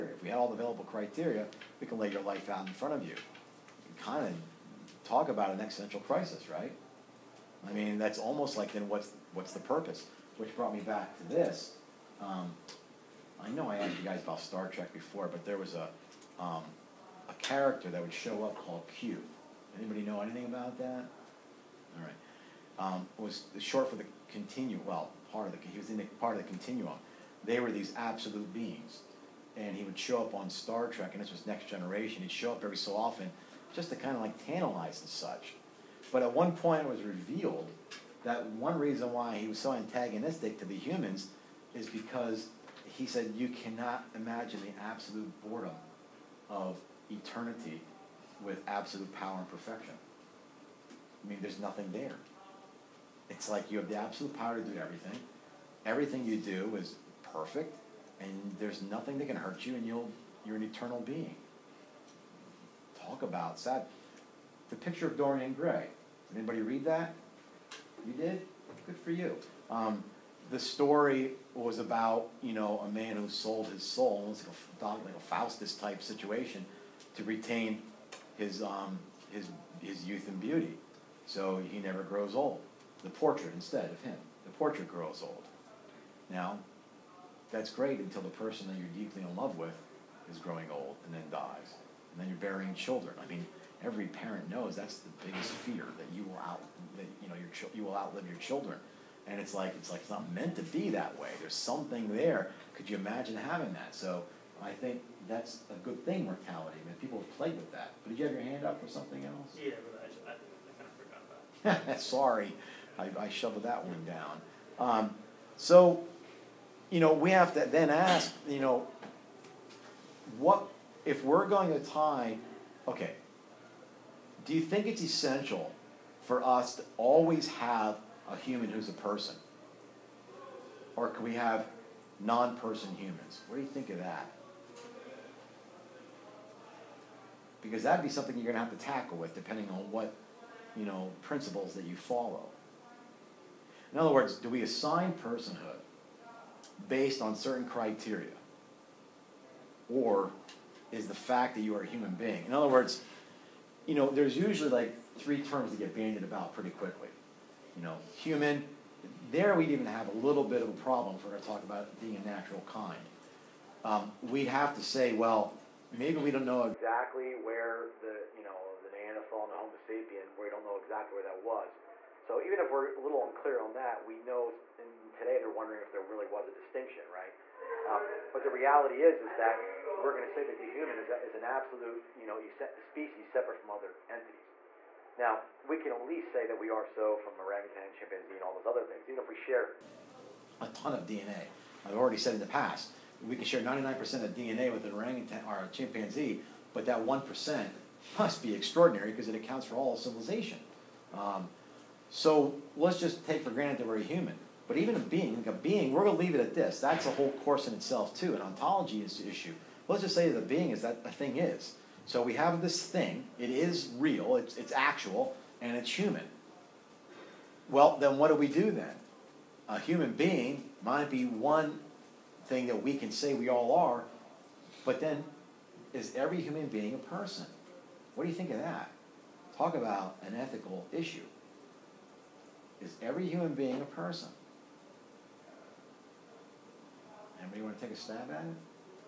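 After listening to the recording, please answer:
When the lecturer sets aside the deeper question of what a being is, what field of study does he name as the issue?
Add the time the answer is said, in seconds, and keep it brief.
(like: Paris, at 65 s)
ontology, at 208 s.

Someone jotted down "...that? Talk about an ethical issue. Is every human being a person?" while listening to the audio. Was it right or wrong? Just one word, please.
right.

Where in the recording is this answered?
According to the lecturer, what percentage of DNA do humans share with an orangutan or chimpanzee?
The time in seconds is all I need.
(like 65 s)
193 s.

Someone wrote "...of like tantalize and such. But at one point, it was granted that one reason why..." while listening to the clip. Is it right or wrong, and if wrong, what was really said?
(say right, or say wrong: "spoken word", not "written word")
wrong: "revealed", not "granted".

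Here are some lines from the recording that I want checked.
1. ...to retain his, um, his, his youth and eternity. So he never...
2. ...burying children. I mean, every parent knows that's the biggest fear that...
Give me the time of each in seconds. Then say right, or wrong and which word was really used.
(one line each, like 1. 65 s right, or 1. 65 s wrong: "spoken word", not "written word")
1. 77 s wrong: "beauty", not "eternity"
2. 92 s right.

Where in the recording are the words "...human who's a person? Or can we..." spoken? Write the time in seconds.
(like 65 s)
128 s.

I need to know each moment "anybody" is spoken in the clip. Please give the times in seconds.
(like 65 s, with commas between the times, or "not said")
19 s, 66 s, 237 s.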